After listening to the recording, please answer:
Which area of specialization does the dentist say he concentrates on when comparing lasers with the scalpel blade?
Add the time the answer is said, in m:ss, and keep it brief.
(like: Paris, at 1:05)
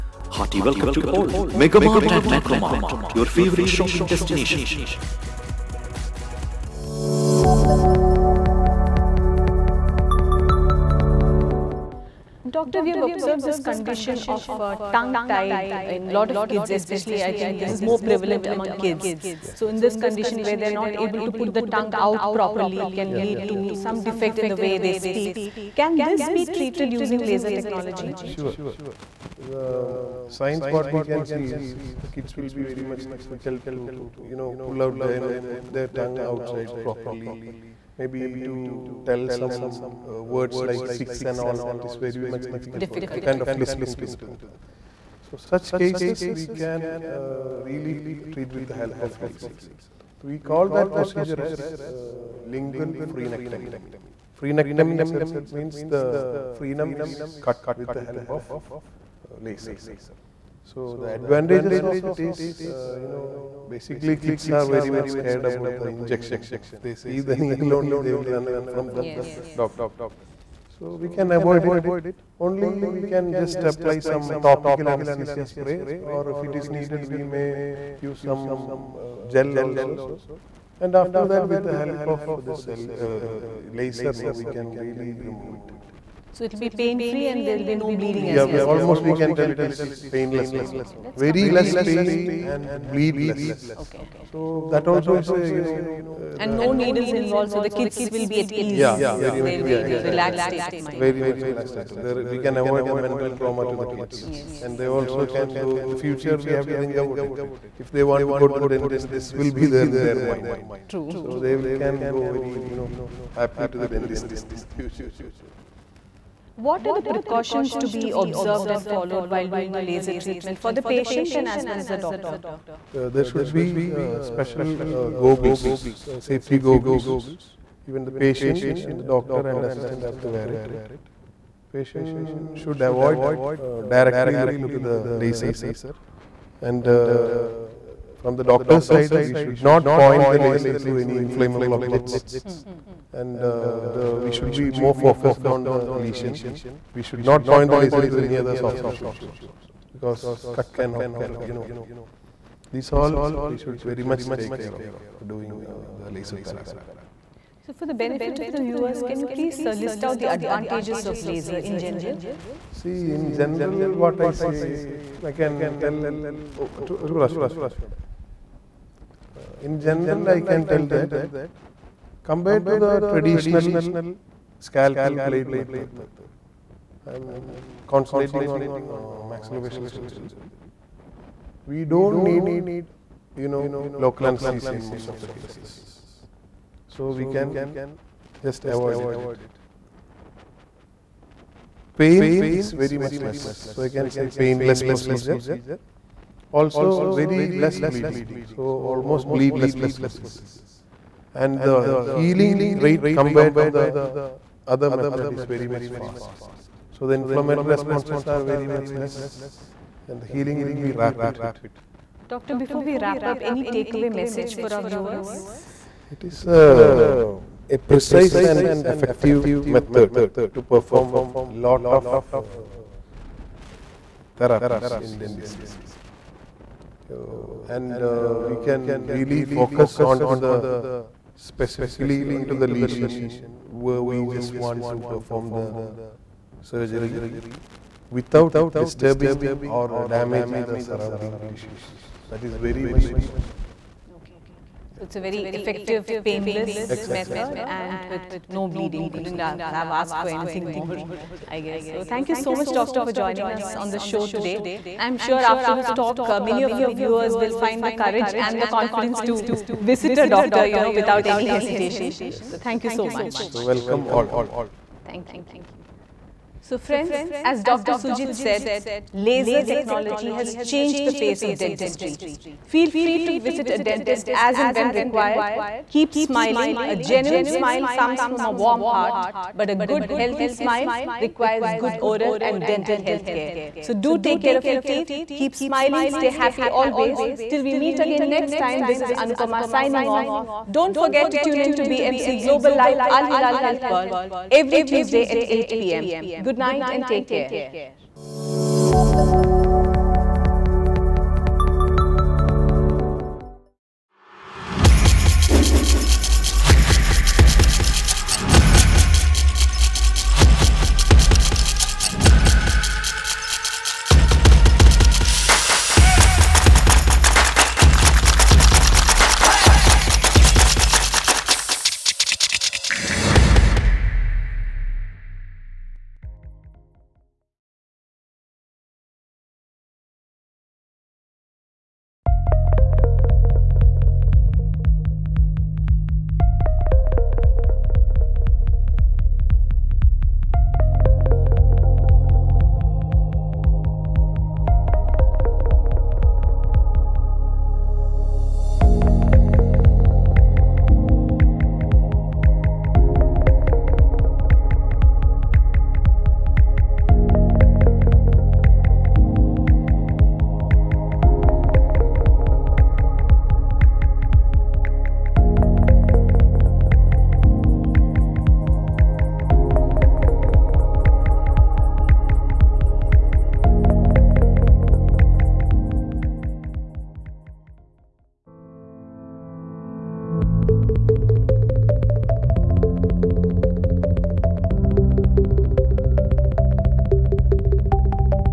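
Maxillofacial surgery, at 2:59.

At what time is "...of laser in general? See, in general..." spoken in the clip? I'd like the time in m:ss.
2:41.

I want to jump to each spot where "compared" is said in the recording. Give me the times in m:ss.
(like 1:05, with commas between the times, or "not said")
2:52, 3:23.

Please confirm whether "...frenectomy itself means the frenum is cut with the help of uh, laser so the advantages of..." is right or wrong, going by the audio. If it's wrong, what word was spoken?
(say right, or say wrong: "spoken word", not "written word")
right.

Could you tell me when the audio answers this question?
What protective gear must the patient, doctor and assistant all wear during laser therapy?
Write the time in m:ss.
2:06.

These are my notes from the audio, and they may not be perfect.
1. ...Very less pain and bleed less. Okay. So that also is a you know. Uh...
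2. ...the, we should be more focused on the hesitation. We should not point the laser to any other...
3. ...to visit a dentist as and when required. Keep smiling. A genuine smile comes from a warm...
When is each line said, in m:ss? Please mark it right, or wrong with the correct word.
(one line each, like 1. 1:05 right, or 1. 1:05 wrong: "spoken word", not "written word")
1. 1:31 right
2. 2:23 wrong: "lesion", not "hesitation"
3. 4:33 right.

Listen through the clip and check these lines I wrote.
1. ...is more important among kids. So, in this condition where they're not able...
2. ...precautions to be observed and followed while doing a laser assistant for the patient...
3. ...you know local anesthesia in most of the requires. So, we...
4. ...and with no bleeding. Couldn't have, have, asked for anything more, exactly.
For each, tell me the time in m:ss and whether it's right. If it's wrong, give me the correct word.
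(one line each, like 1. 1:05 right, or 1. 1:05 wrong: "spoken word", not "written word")
1. 0:17 wrong: "prevalent", not "important"
2. 1:57 wrong: "treatment", not "assistant"
3. 3:03 wrong: "cases", not "requires"
4. 4:07 right.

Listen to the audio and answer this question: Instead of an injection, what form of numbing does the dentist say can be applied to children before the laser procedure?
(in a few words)
Topical anesthesia spray.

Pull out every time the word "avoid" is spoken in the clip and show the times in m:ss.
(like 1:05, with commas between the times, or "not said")
1:11, 1:42, 2:12, 3:08.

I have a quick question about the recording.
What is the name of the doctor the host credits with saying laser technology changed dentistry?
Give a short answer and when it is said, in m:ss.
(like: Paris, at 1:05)
Dr. Sujith, at 4:27.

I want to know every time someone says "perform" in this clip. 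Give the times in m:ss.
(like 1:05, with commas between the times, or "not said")
3:40, 3:55.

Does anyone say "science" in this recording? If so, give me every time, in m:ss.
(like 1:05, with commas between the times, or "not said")
0:30.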